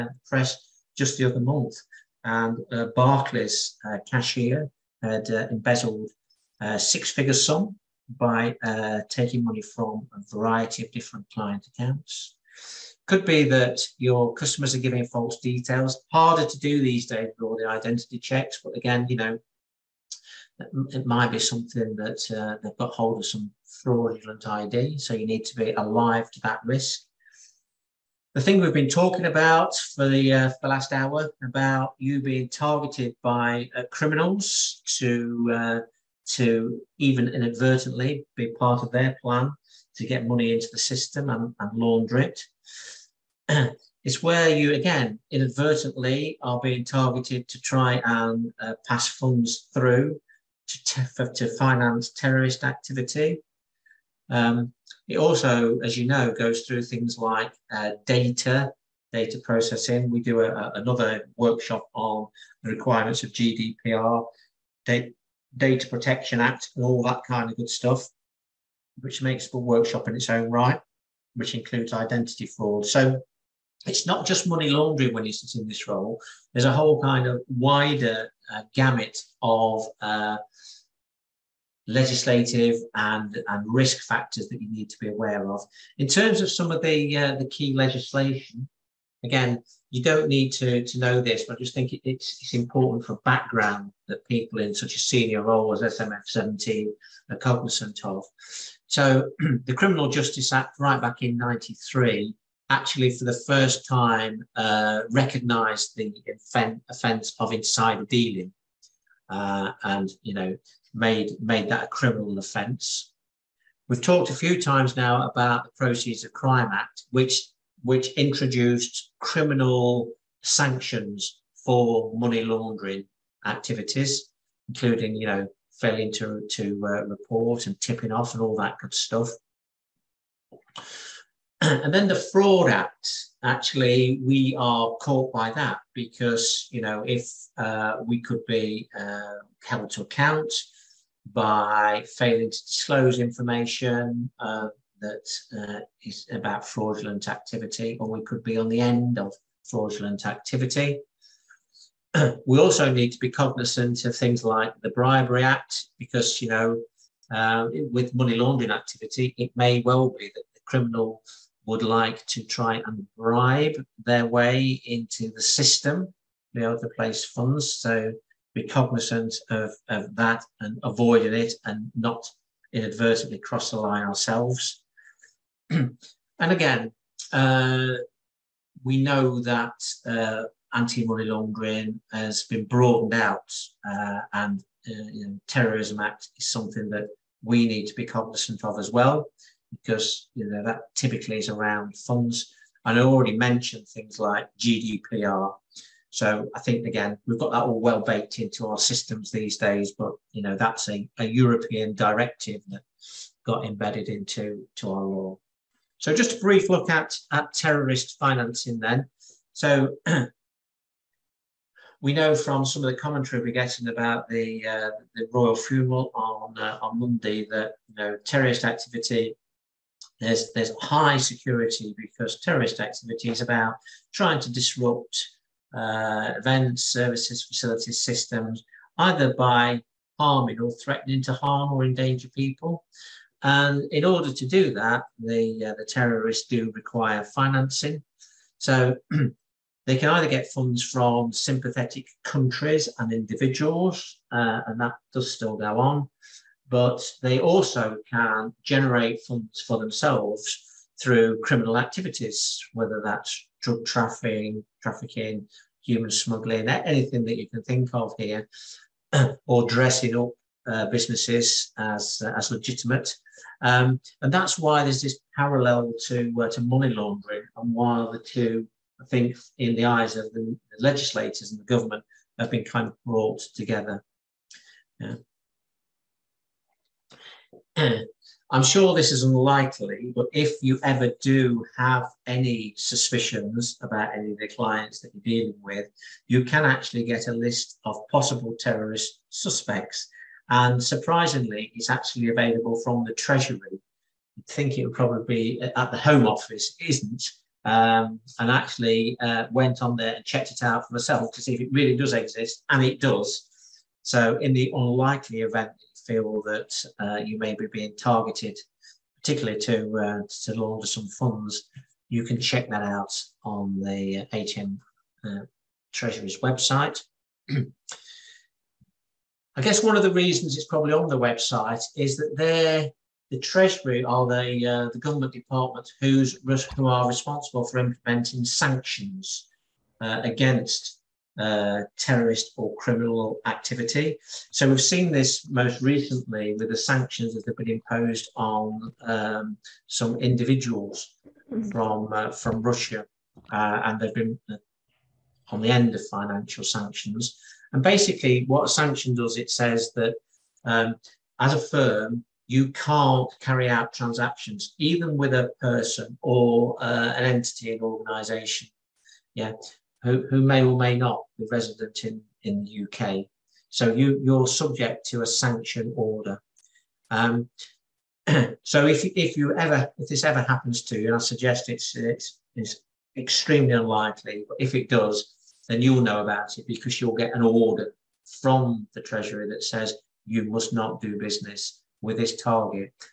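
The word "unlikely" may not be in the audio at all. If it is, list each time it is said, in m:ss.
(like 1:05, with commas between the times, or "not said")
4:39, 5:04, 6:13.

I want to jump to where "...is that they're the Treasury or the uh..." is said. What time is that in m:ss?
5:21.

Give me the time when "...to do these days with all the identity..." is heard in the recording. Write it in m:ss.
0:16.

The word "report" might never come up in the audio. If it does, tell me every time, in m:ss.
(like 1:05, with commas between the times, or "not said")
2:07.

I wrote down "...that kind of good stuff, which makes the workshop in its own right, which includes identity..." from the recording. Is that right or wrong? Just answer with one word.
right.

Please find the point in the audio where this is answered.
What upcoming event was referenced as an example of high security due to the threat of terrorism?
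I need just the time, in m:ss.
3:35.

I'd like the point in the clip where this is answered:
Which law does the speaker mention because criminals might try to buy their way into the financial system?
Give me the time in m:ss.
2:34.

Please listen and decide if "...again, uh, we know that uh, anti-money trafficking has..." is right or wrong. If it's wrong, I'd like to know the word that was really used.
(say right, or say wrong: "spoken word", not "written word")
wrong: "laundering", not "trafficking".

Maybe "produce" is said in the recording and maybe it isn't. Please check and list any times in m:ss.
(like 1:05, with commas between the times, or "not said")
not said.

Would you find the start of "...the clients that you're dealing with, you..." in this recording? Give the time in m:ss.
4:44.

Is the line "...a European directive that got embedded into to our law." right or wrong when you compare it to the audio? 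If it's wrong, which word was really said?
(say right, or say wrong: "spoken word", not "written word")
right.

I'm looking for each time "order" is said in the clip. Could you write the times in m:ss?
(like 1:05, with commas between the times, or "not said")
3:54, 6:05, 6:17.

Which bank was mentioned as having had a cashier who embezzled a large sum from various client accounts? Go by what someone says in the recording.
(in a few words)
Barclays.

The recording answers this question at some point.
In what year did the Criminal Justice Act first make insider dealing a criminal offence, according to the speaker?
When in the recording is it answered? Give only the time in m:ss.
1:41.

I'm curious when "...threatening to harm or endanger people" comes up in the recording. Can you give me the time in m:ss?
3:50.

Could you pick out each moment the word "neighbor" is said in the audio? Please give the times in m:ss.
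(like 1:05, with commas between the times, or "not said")
not said.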